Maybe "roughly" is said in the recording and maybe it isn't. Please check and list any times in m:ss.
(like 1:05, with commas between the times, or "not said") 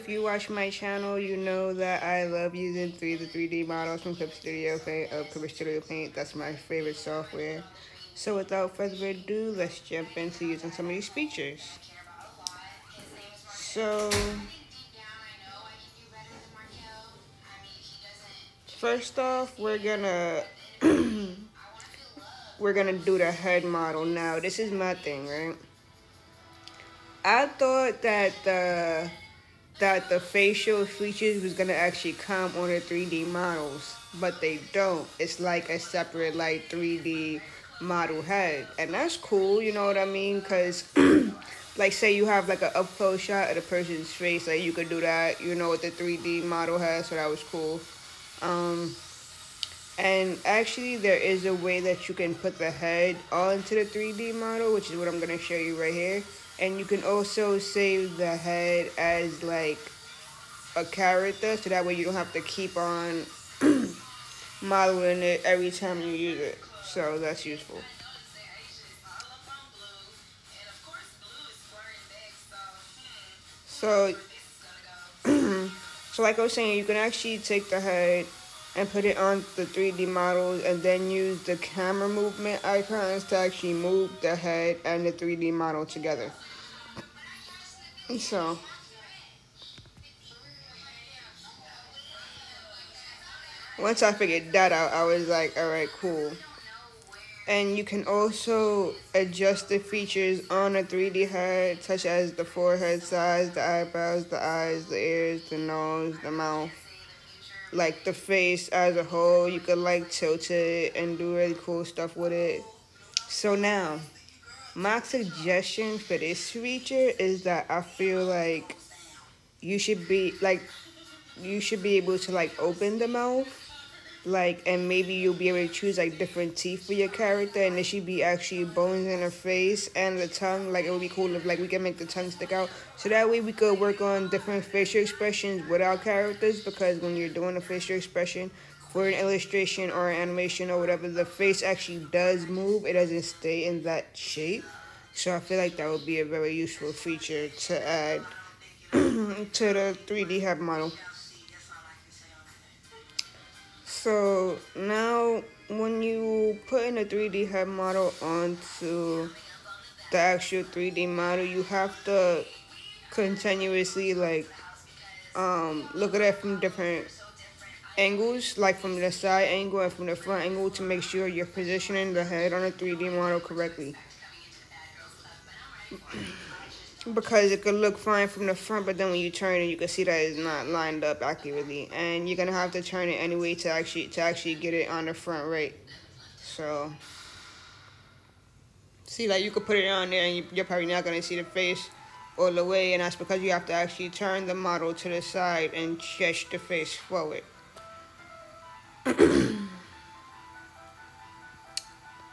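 not said.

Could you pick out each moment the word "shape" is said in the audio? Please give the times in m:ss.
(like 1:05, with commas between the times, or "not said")
2:24.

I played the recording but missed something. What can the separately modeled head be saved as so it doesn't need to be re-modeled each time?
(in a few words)
a character.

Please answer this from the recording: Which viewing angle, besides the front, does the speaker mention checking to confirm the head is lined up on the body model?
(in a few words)
side angle.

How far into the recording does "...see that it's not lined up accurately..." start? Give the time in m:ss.
2:59.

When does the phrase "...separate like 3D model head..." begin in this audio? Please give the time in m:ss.
0:35.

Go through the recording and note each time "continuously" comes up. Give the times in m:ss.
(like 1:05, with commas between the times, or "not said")
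2:43.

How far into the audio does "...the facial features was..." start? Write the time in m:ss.
0:30.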